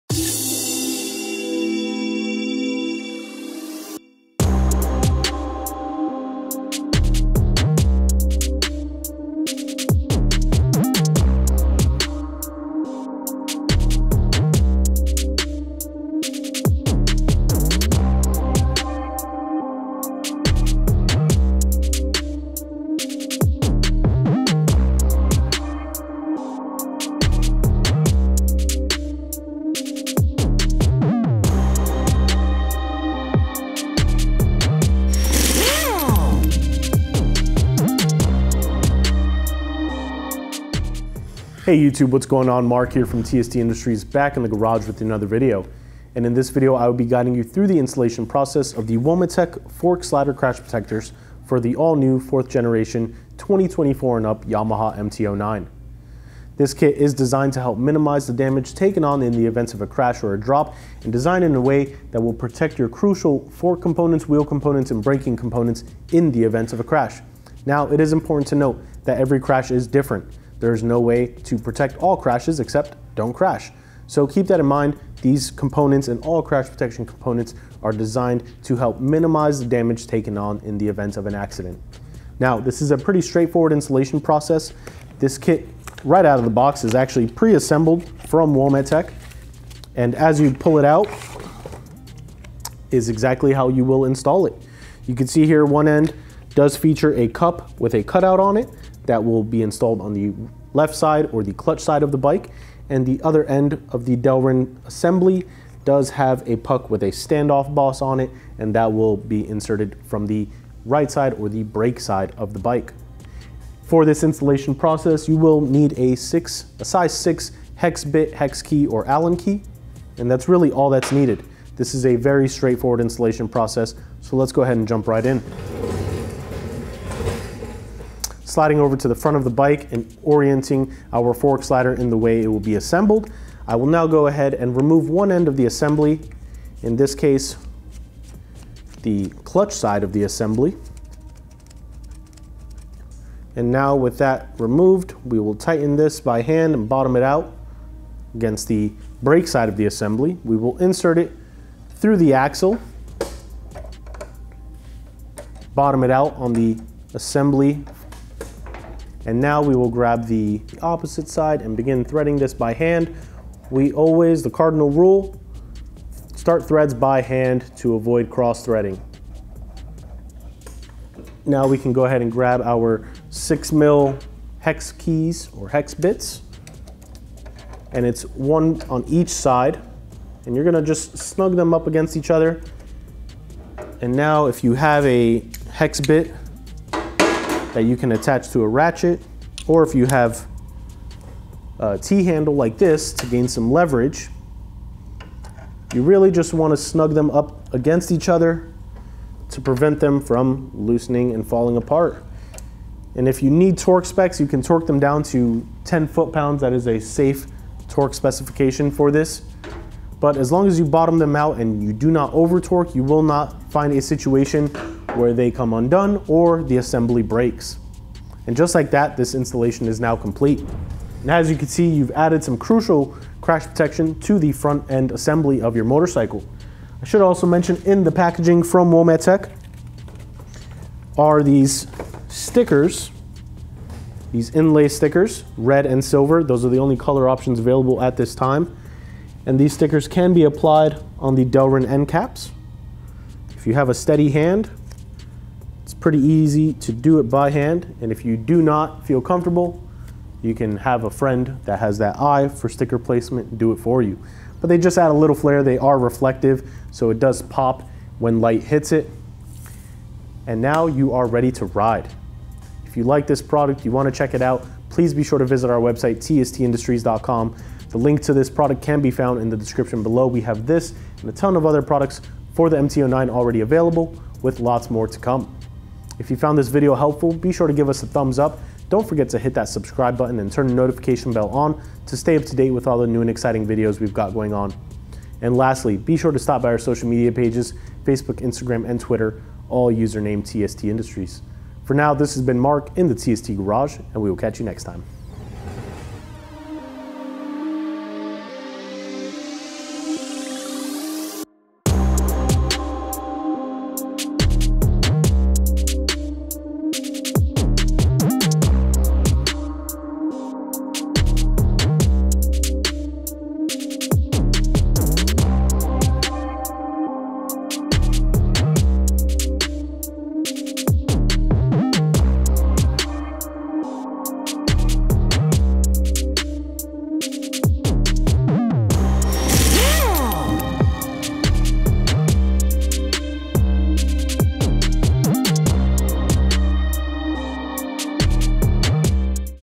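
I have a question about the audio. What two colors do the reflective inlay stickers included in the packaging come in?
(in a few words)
Red and silver.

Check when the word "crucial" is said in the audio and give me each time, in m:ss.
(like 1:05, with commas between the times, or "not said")
1:02, 3:42.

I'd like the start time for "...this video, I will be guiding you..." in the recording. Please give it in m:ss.
0:46.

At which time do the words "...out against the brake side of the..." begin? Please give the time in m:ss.
2:27.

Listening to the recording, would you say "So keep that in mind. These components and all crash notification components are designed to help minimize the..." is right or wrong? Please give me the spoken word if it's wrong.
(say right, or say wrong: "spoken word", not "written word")
wrong: "protection", not "notification".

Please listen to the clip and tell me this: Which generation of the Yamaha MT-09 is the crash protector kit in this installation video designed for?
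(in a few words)
Fourth generation.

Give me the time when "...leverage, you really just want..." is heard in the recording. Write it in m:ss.
3:13.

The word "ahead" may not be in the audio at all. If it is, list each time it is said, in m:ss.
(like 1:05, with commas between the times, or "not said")
2:04, 2:14, 2:52.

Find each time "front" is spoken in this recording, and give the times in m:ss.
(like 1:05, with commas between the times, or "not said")
2:09, 3:44.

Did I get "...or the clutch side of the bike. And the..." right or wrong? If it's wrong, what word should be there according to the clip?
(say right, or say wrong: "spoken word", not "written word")
right.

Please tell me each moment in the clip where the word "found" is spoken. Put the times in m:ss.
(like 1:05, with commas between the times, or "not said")
4:29, 4:36.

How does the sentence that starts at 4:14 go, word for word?
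But they just add a little flair.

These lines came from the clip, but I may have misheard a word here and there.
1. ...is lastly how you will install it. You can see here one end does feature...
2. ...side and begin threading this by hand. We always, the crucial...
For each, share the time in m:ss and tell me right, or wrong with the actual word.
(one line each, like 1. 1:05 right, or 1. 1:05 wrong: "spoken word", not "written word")
1. 1:32 wrong: "exactly", not "lastly"
2. 2:41 wrong: "cardinal", not "crucial".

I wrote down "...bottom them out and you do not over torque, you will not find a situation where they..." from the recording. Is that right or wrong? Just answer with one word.
right.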